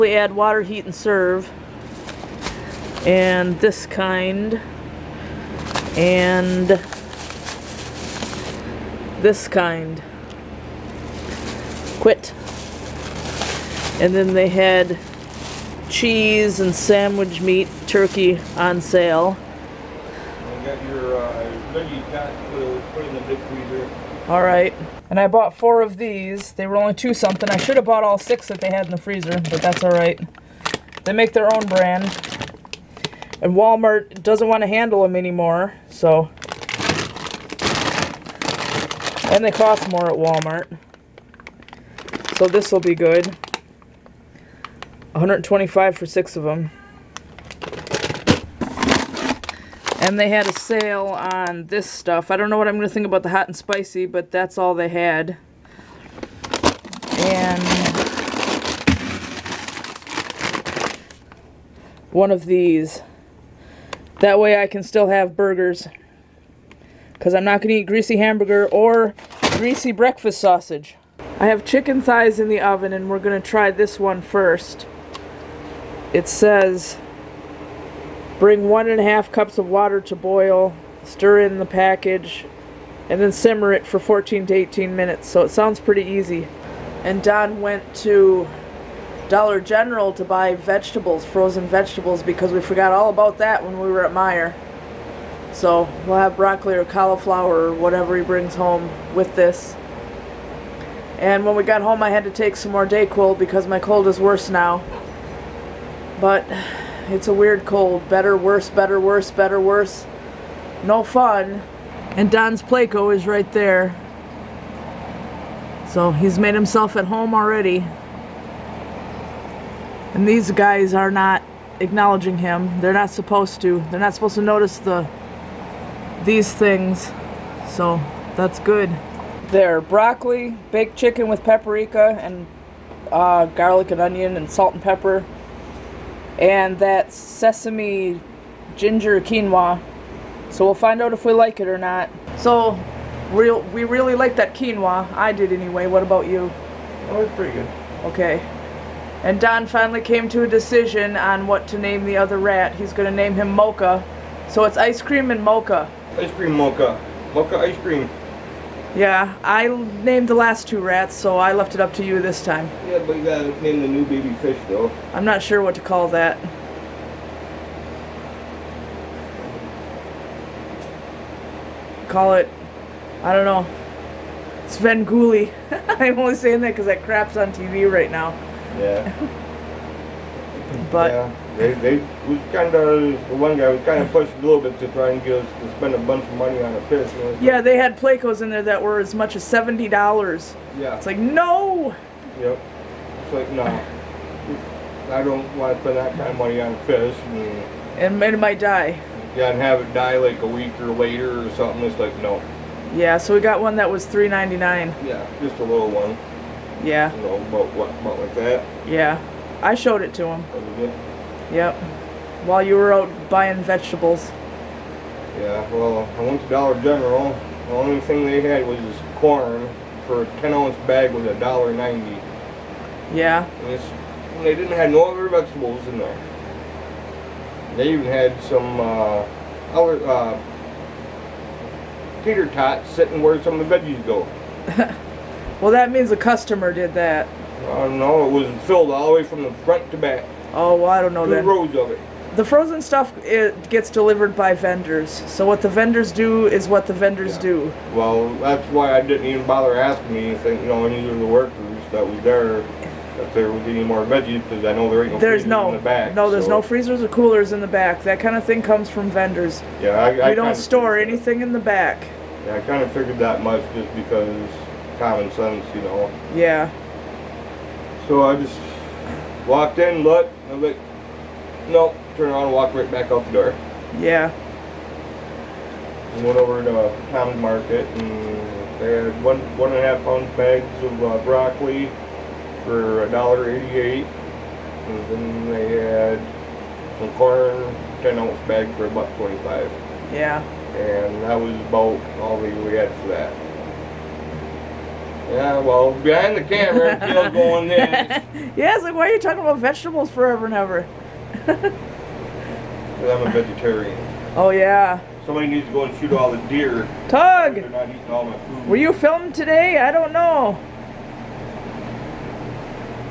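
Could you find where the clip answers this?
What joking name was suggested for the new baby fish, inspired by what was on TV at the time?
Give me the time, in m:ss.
2:54.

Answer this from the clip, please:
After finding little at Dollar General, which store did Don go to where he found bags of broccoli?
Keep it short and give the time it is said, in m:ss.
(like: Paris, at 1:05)
Town Market, at 4:37.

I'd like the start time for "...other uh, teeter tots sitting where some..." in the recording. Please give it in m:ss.
3:49.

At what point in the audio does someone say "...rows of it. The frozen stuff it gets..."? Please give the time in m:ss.
4:01.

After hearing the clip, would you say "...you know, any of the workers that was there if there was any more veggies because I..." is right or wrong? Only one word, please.
right.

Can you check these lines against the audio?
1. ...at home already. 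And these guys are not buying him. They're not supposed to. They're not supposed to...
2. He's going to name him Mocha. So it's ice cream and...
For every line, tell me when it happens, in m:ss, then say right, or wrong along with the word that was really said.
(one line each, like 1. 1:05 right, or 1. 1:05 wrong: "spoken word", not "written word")
1. 1:56 wrong: "acknowledging", not "buying"
2. 2:32 right.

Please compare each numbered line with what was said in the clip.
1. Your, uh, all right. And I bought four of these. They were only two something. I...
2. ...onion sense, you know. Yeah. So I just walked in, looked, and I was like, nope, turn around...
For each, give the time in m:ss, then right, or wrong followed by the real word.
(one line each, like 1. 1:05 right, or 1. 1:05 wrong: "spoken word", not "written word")
1. 0:20 right
2. 4:24 wrong: "common", not "onion".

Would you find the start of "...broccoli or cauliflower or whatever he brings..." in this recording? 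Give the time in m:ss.
1:36.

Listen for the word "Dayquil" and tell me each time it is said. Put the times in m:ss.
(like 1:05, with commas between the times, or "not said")
1:42.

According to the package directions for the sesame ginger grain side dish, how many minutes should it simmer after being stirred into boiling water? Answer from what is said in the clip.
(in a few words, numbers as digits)
14 to 18.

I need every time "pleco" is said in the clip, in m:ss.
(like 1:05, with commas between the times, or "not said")
1:52, 3:07.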